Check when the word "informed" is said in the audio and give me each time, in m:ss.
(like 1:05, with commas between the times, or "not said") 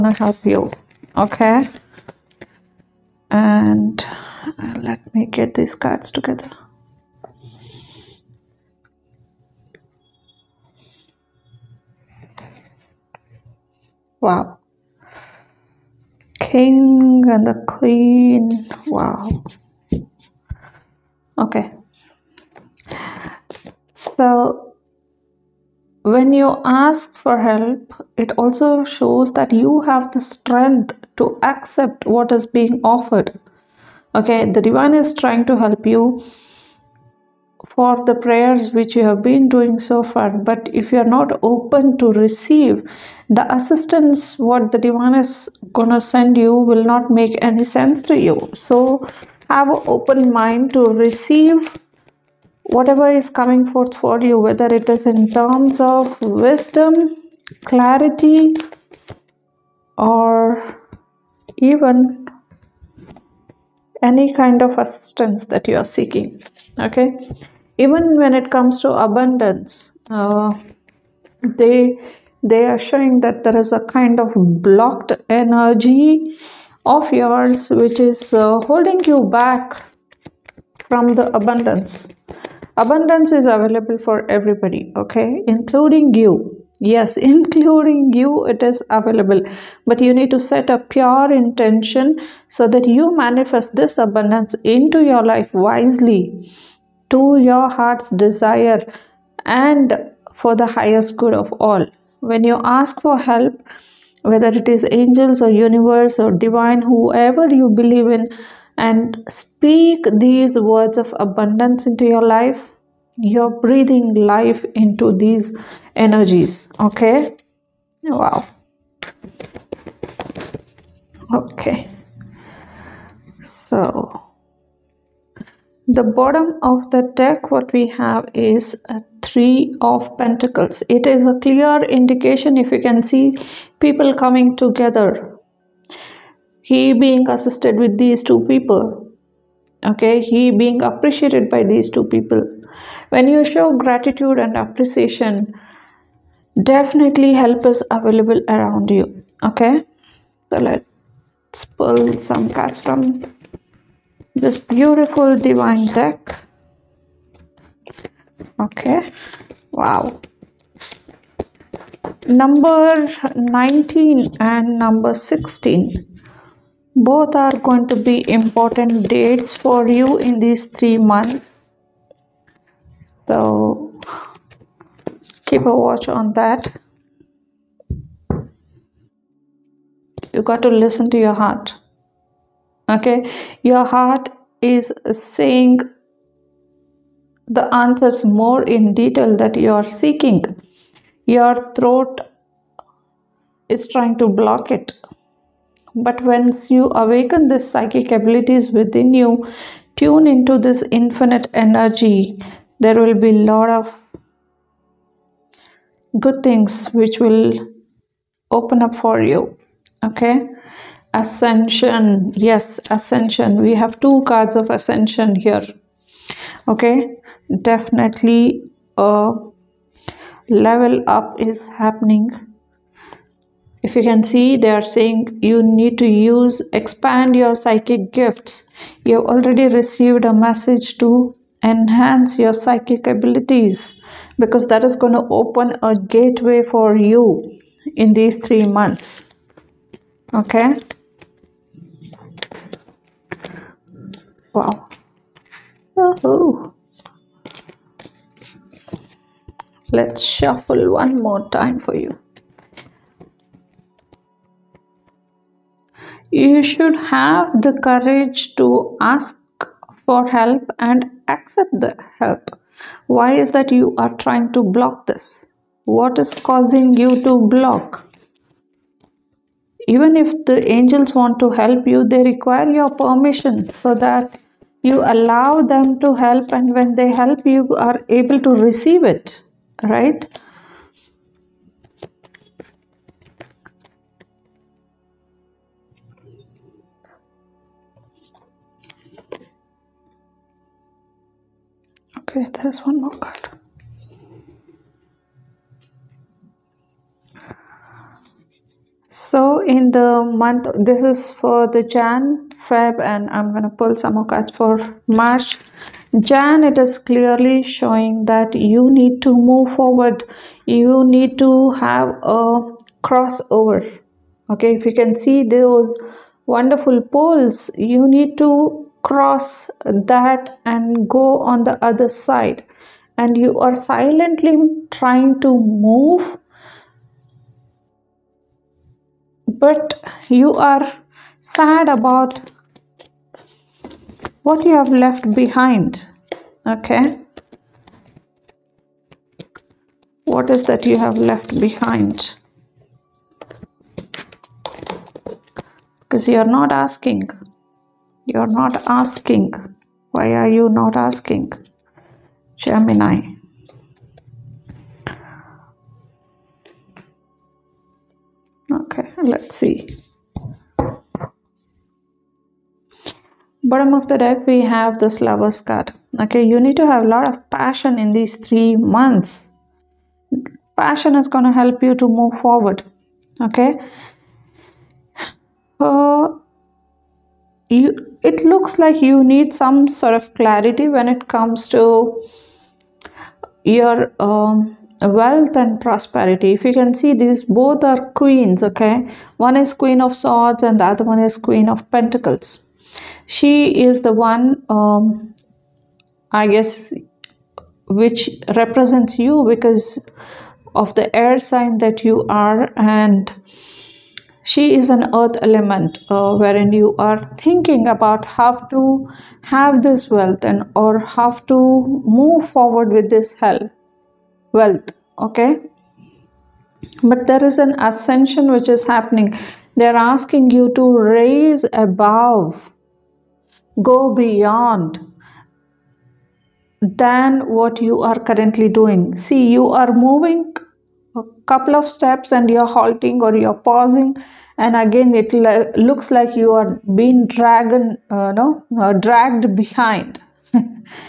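not said.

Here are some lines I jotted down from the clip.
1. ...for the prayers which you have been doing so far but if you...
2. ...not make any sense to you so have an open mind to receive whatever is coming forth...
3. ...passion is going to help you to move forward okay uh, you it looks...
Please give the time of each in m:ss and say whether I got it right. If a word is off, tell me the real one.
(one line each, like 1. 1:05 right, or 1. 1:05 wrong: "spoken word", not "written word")
1. 0:37 right
2. 0:46 right
3. 6:10 right.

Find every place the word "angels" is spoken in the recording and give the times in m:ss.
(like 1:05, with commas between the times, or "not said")
1:44, 4:30.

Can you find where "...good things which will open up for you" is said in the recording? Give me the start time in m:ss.
3:26.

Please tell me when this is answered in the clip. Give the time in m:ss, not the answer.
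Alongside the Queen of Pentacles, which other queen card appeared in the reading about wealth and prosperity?
6:29.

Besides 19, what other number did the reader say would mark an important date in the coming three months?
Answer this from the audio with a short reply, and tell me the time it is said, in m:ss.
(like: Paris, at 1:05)
16, at 2:44.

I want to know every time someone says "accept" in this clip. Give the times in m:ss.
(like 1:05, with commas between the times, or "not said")
0:31, 4:21.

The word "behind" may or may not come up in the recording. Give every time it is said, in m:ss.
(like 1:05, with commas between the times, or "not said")
5:35, 5:41, 7:19.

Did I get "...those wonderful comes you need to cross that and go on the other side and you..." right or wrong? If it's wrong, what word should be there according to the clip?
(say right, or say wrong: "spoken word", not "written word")
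wrong: "poles", not "comes".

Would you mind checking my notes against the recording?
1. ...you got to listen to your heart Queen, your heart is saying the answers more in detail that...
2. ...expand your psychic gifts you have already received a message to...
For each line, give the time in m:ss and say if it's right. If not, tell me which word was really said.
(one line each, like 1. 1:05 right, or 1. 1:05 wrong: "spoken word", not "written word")
1. 3:00 wrong: "Okay", not "Queen"
2. 3:46 right.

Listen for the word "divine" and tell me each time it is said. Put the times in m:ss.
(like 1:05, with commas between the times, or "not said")
0:34, 0:44, 1:46, 2:35.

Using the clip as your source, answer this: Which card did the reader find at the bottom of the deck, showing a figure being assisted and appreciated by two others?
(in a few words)
Three of Pentacles.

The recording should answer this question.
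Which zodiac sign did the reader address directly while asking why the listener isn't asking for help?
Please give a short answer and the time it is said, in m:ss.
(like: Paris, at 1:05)
Gemini, at 5:52.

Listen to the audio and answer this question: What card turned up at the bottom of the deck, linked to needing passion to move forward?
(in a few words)
Lovers.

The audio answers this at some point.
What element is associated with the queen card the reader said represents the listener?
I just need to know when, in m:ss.
6:45.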